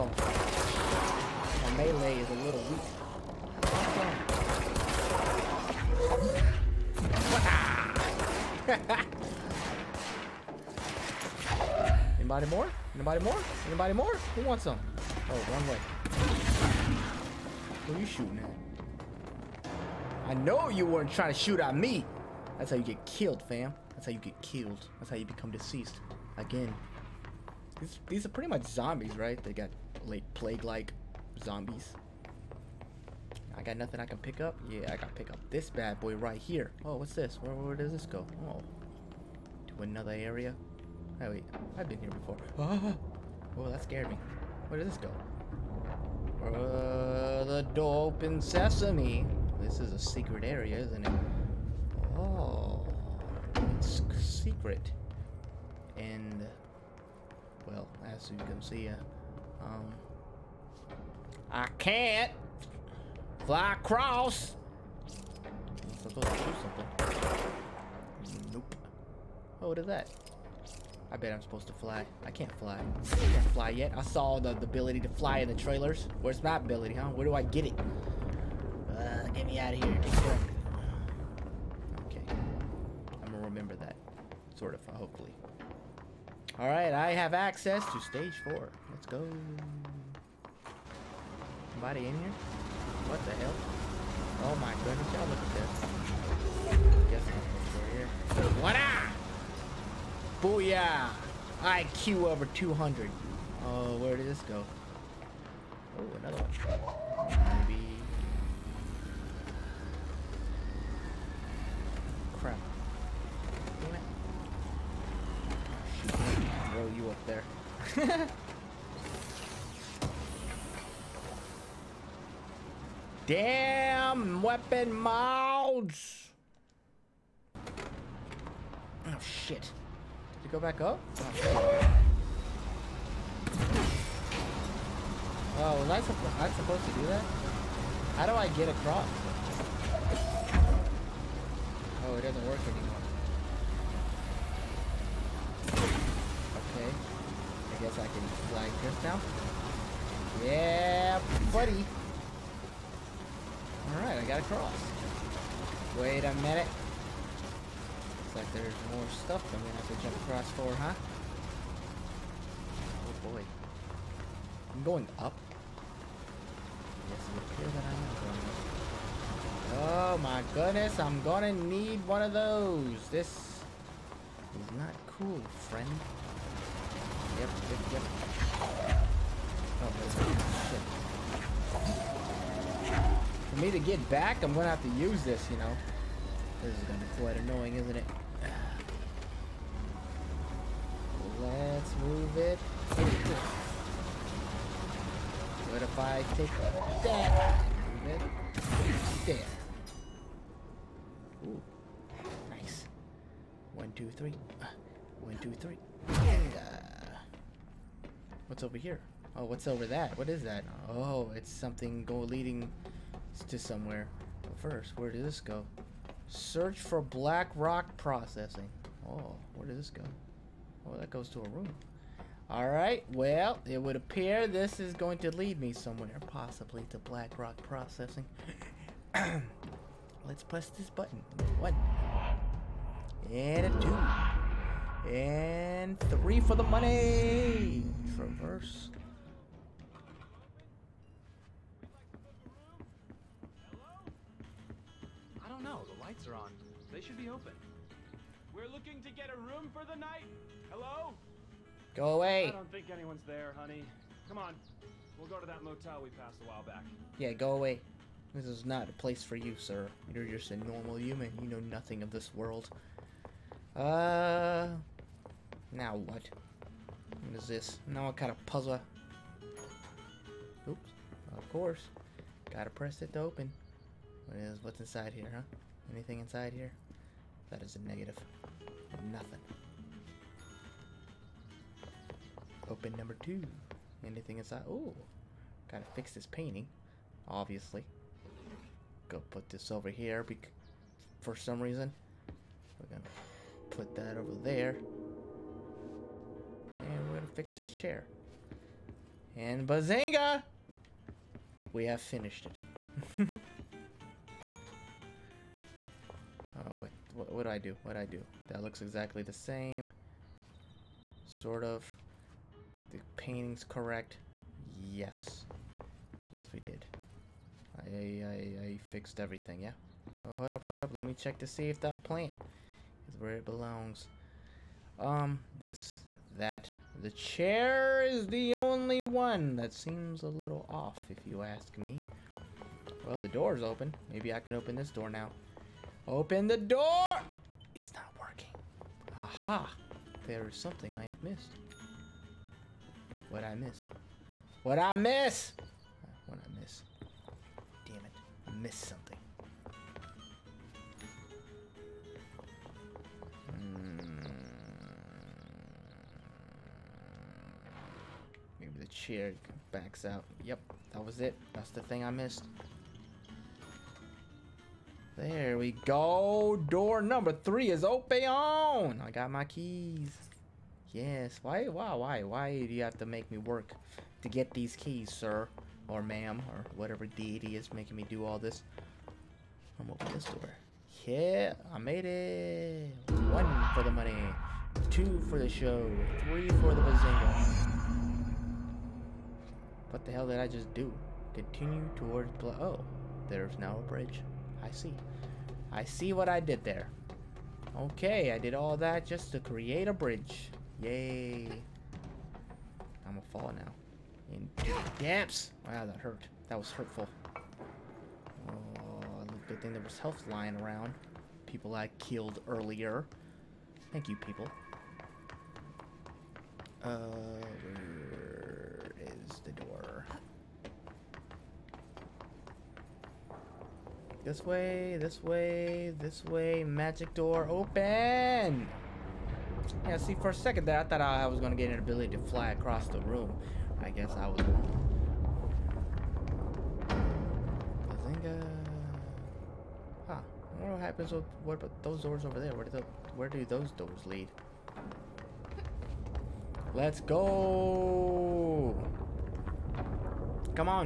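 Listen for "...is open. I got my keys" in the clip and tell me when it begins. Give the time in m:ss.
6:07.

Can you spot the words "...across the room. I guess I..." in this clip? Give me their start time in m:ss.
7:12.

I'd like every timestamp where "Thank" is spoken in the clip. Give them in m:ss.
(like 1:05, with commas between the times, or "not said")
6:53.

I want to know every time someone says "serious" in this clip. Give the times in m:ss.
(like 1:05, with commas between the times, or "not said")
not said.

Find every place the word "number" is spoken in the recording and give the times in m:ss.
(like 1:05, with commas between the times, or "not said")
4:42, 6:07.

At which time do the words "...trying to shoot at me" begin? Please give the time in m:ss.
0:21.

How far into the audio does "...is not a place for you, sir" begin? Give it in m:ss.
4:18.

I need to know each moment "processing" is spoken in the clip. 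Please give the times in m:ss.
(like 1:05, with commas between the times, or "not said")
3:37, 3:47.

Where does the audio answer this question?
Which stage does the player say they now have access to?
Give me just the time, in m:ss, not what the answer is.
1:28.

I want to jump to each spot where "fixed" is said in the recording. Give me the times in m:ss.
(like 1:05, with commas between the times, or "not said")
5:18.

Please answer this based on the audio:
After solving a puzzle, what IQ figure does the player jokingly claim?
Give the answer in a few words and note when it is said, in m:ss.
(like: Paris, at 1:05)
over 200, at 1:41.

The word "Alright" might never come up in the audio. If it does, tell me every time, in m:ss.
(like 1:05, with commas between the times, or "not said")
1:26, 2:33, 3:42.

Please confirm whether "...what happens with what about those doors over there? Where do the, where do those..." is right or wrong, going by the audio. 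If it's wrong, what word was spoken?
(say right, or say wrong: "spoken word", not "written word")
right.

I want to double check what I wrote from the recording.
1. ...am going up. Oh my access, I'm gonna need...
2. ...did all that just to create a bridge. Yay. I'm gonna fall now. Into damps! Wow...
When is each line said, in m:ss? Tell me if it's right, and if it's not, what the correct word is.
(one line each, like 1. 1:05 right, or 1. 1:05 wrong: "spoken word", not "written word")
1. 2:49 wrong: "goodness", not "access"
2. 6:38 right.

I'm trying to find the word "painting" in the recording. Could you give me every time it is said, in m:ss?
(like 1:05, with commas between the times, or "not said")
4:46, 5:13.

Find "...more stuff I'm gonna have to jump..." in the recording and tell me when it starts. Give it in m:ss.
2:38.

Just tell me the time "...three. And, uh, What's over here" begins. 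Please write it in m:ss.
3:25.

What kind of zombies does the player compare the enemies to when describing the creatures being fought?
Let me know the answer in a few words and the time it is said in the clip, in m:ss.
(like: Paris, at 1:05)
plague-like zombies, at 0:30.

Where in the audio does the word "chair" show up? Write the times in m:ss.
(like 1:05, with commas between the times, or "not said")
4:57, 5:27, 5:58.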